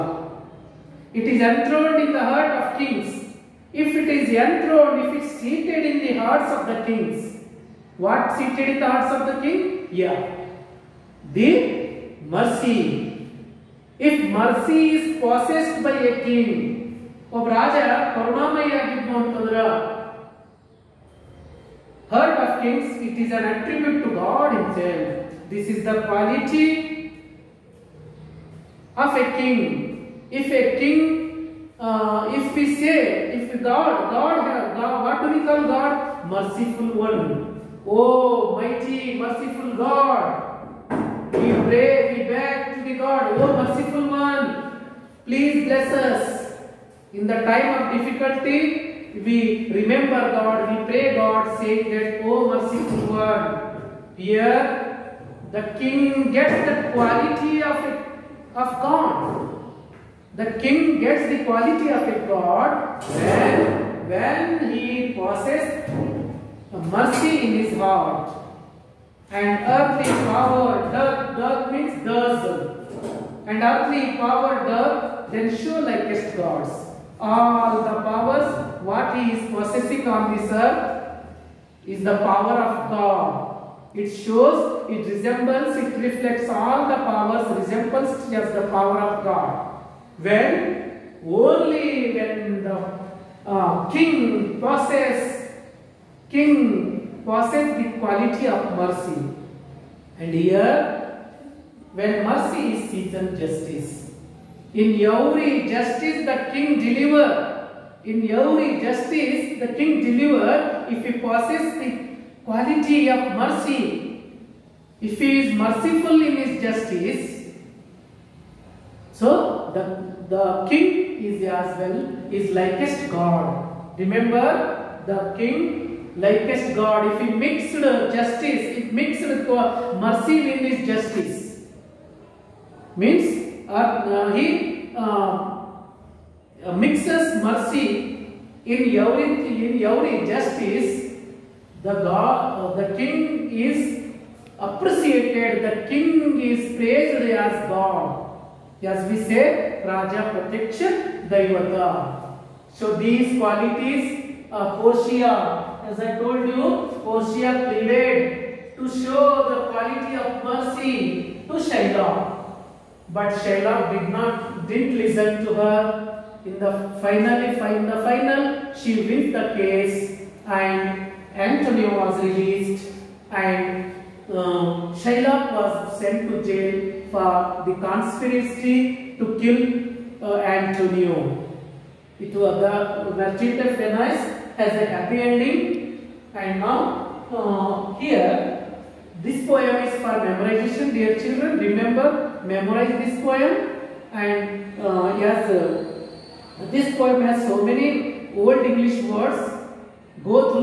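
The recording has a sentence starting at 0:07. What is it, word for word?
What seated in the hearts of the king?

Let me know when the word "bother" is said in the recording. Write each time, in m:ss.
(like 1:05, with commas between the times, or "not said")
not said.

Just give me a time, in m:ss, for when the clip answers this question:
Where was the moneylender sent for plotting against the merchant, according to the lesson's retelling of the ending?
2:56.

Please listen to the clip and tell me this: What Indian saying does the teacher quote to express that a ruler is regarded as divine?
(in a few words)
Raja Protection Daivata.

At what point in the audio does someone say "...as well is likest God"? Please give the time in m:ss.
2:01.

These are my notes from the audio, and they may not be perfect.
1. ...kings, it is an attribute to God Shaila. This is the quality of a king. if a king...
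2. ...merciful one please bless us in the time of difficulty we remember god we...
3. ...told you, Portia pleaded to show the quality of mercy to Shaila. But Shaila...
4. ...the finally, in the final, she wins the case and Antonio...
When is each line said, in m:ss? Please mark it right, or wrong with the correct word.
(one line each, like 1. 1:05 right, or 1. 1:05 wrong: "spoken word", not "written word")
1. 0:22 wrong: "Himself", not "Shaila"
2. 0:43 right
3. 2:36 right
4. 2:46 right.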